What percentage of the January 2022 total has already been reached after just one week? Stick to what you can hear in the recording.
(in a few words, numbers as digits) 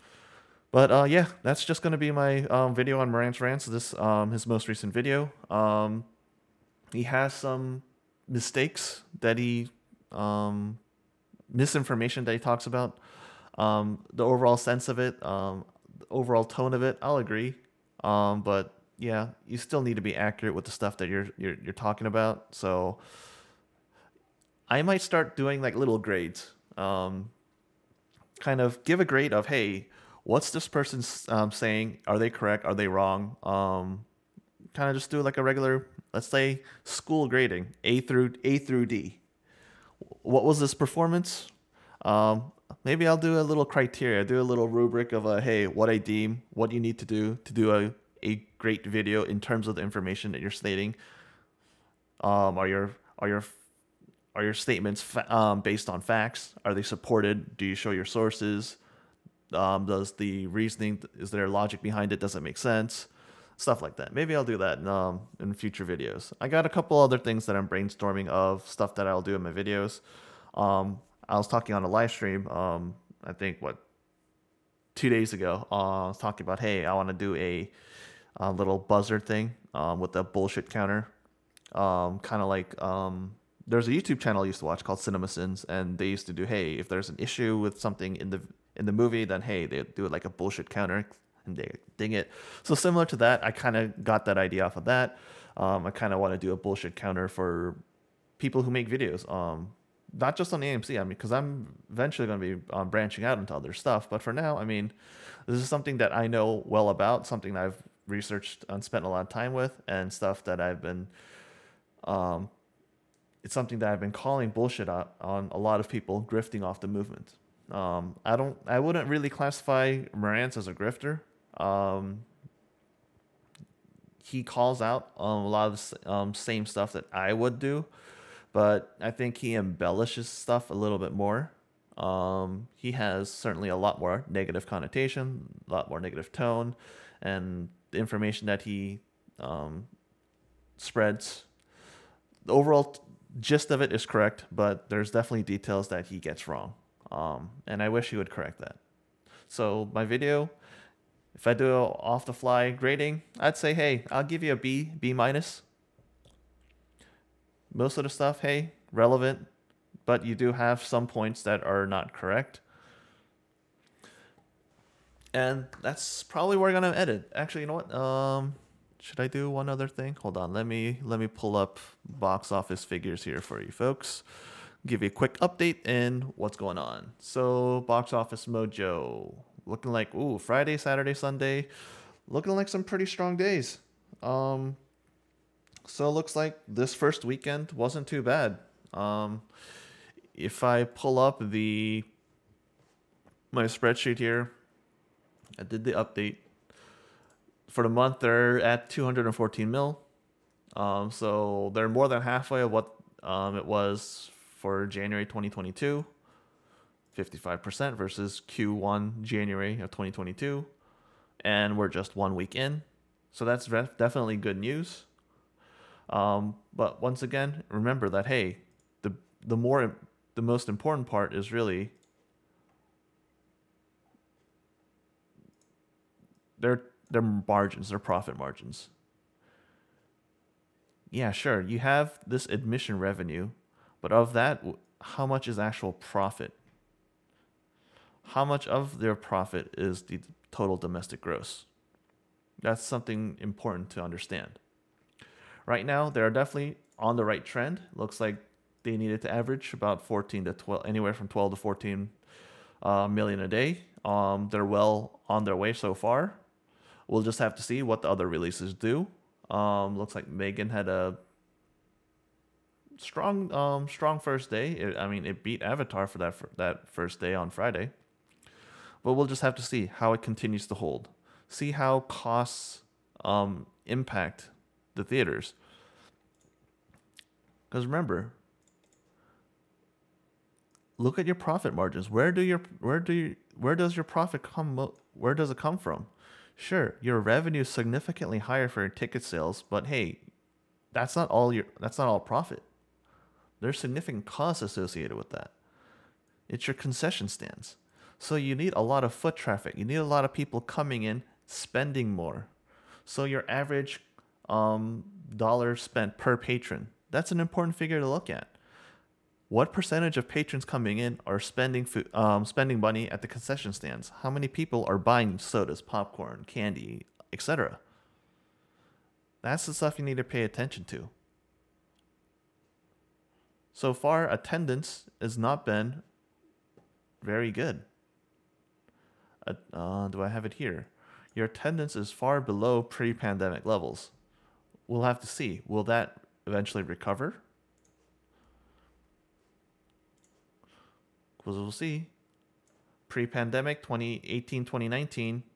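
55%.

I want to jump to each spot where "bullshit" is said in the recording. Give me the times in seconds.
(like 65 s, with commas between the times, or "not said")
80 s, 90 s, 96 s, 114 s.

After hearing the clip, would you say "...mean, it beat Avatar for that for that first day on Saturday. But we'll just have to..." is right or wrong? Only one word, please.
wrong.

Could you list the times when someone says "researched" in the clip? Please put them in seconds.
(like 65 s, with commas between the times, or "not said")
108 s.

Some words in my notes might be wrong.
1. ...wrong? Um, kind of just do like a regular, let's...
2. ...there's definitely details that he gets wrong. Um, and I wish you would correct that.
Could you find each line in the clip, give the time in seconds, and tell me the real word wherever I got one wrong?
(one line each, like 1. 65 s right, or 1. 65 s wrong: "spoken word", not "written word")
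1. 32 s right
2. 144 s right.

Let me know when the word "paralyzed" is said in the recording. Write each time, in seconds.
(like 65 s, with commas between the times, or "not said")
not said.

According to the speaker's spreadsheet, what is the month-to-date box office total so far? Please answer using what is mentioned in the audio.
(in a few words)
214 million.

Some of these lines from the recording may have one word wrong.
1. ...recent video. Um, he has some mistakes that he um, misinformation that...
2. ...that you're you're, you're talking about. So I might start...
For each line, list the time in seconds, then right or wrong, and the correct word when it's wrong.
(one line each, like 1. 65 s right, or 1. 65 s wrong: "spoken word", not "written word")
1. 4 s right
2. 20 s right.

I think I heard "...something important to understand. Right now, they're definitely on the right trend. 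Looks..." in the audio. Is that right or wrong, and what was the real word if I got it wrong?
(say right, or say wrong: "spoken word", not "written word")
right.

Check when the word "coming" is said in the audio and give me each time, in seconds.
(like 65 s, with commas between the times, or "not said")
300 s, 310 s.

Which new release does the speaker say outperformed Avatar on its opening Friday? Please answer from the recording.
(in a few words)
Megan.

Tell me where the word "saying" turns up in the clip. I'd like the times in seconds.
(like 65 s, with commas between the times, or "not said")
31 s.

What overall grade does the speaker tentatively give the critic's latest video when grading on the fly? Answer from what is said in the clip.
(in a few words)
B minus.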